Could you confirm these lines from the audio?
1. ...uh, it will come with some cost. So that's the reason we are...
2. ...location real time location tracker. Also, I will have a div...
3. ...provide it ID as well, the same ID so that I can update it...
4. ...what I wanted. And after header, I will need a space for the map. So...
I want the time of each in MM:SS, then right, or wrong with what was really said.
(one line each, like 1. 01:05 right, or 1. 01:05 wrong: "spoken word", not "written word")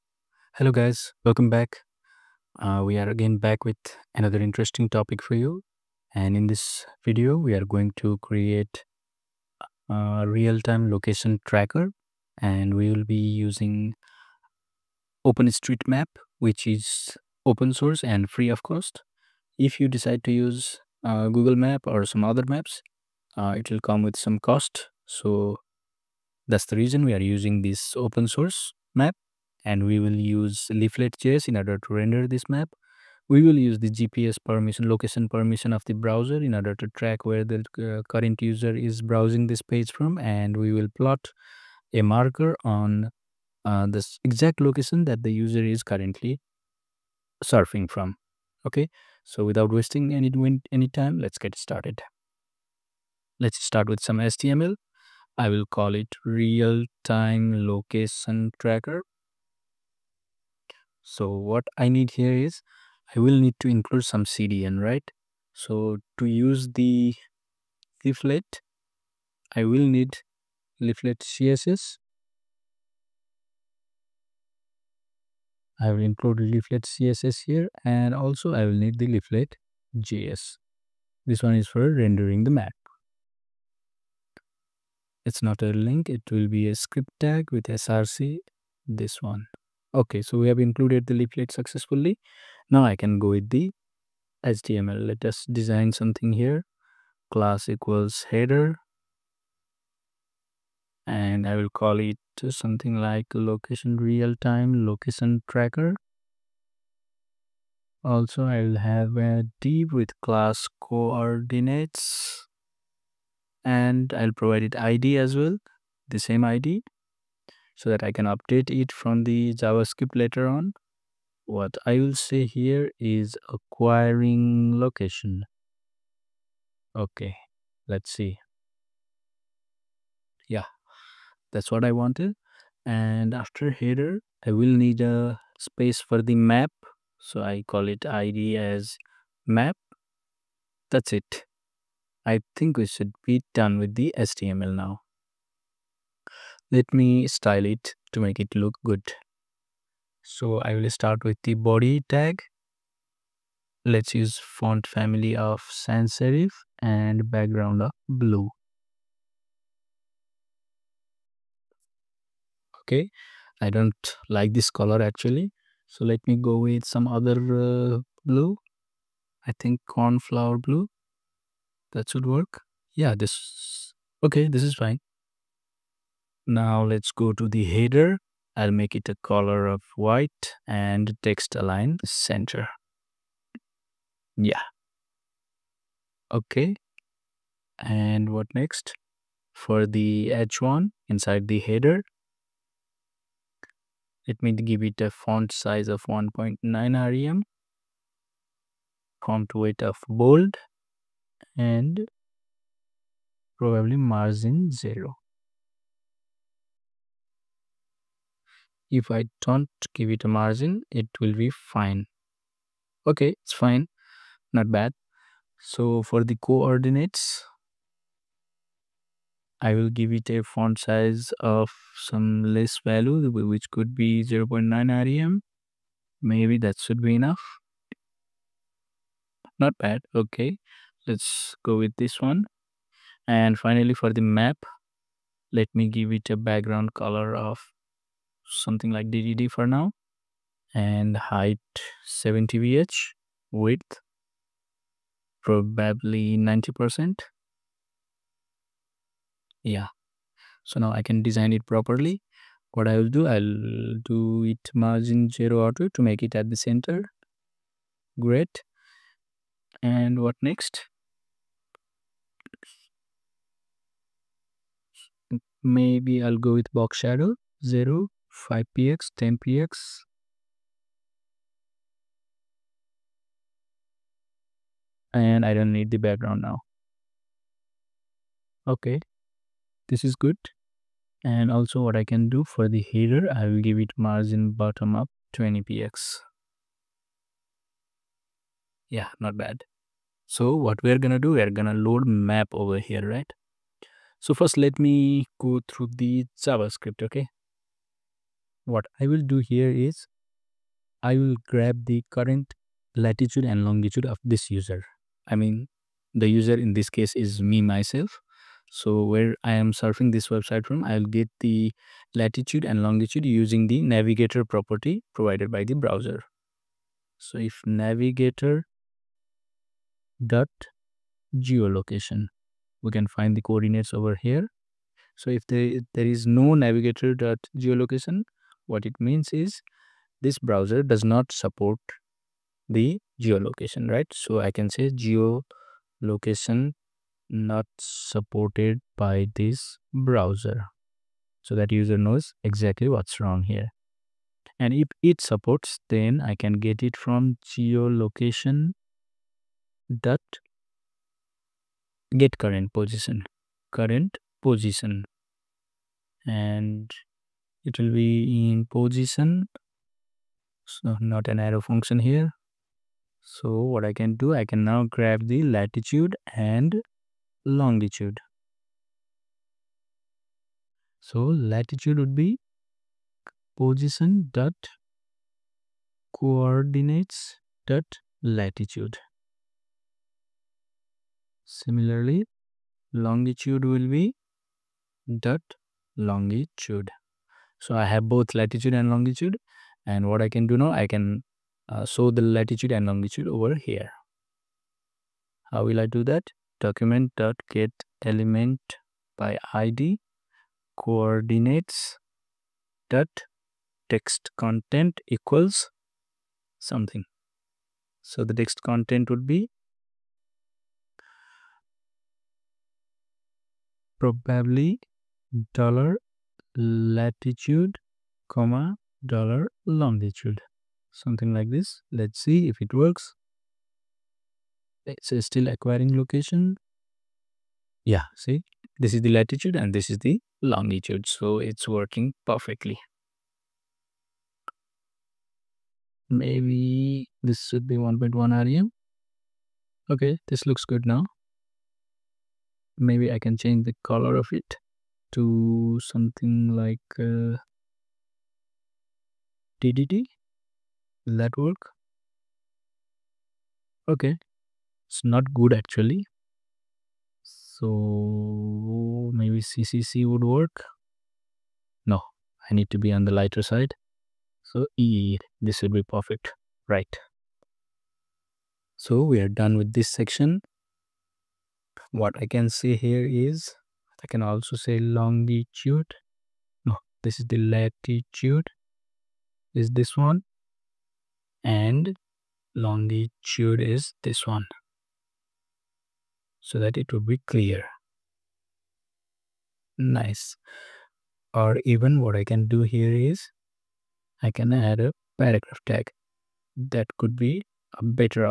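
1. 00:23 right
2. 01:43 right
3. 01:54 right
4. 02:11 right.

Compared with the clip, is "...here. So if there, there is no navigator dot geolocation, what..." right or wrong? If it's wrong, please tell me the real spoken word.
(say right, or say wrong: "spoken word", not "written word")
right.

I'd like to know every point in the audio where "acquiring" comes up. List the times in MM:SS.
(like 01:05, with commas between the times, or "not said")
02:03, 07:05.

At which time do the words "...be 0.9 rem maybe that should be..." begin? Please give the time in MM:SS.
03:43.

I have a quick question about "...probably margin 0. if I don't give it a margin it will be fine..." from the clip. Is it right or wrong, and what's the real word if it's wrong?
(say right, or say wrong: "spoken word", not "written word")
right.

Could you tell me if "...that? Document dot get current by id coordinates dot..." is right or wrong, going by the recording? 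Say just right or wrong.
wrong.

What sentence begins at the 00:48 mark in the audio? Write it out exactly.
Okay, so without wasting any, any time, let's get started.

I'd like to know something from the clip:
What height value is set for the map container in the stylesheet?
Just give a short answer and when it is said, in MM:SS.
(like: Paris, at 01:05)
70 VH, at 04:02.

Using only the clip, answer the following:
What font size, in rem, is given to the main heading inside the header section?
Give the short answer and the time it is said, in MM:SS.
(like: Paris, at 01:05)
1.9 rem, at 03:16.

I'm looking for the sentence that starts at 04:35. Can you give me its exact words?
And I don't need the background now.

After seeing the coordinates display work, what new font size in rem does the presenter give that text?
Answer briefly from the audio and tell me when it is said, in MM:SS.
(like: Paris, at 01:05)
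1.1 rem, at 07:17.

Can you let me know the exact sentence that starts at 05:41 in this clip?
So that user knows exactly what's wrong here.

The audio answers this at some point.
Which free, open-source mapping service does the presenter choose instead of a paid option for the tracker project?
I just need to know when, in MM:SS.
00:15.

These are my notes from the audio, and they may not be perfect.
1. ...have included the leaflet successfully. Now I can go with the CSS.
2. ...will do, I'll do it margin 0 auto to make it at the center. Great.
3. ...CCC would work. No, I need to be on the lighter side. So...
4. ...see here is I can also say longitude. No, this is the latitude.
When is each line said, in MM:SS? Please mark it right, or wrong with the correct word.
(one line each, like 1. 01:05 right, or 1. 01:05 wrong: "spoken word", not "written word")
1. 01:30 wrong: "HTML", not "CSS"
2. 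04:12 right
3. 07:39 right
4. 07:52 right.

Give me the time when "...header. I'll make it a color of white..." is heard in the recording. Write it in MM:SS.
02:57.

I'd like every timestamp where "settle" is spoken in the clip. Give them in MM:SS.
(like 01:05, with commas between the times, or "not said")
not said.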